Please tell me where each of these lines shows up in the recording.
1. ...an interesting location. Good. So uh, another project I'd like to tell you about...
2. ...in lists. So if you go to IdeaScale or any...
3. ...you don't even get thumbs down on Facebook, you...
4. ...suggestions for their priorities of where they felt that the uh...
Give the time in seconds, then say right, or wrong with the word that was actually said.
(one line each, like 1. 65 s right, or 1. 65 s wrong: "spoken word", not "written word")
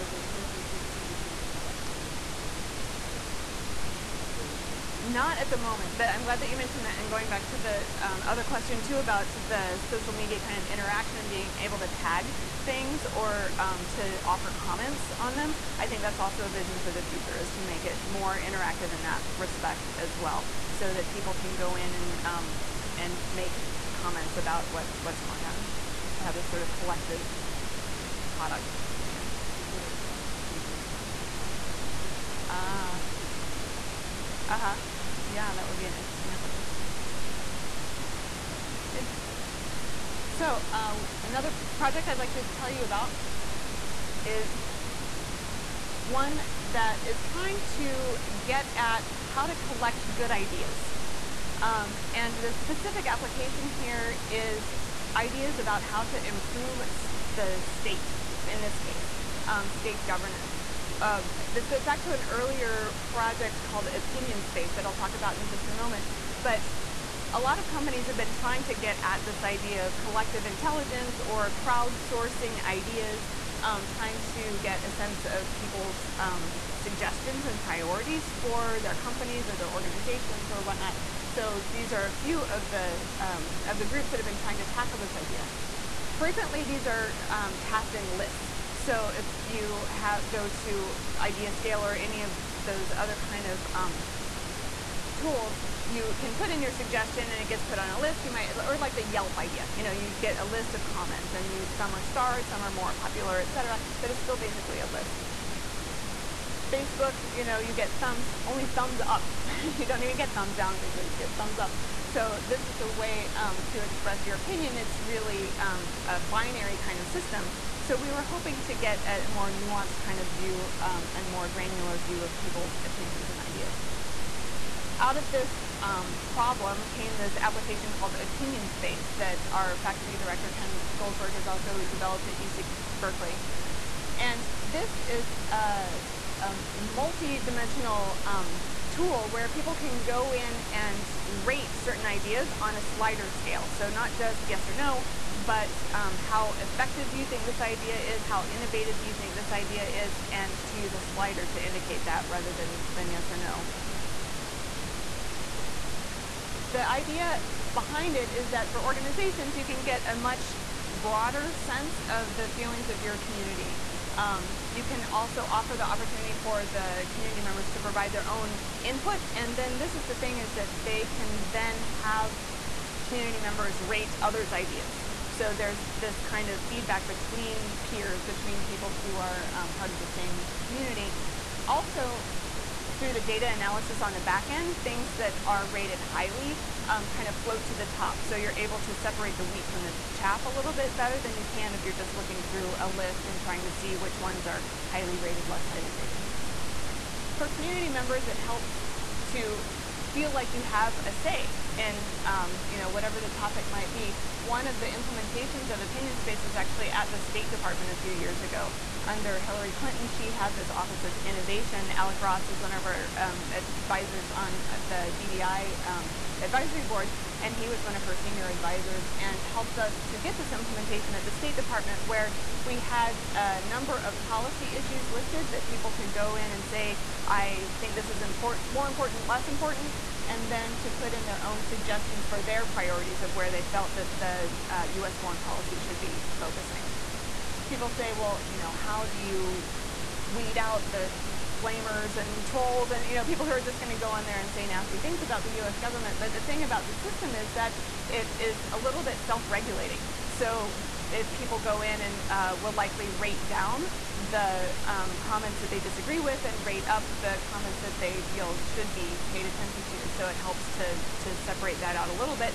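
1. 35 s wrong: "application", not "location"
2. 87 s right
3. 109 s right
4. 231 s right.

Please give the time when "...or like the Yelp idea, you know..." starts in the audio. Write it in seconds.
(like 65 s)
98 s.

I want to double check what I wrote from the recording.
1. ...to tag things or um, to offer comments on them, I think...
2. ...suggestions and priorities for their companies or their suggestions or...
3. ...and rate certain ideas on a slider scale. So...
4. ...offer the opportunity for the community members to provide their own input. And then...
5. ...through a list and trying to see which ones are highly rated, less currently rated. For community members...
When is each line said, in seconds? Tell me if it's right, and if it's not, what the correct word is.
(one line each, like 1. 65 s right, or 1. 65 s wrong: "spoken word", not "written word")
1. 11 s right
2. 76 s wrong: "organizations", not "suggestions"
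3. 140 s right
4. 165 s right
5. 192 s wrong: "highly", not "currently".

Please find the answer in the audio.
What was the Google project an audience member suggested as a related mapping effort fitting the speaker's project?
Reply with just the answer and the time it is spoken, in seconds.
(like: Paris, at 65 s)
Google Timeline, at 30 s.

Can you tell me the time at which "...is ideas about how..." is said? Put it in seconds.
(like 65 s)
54 s.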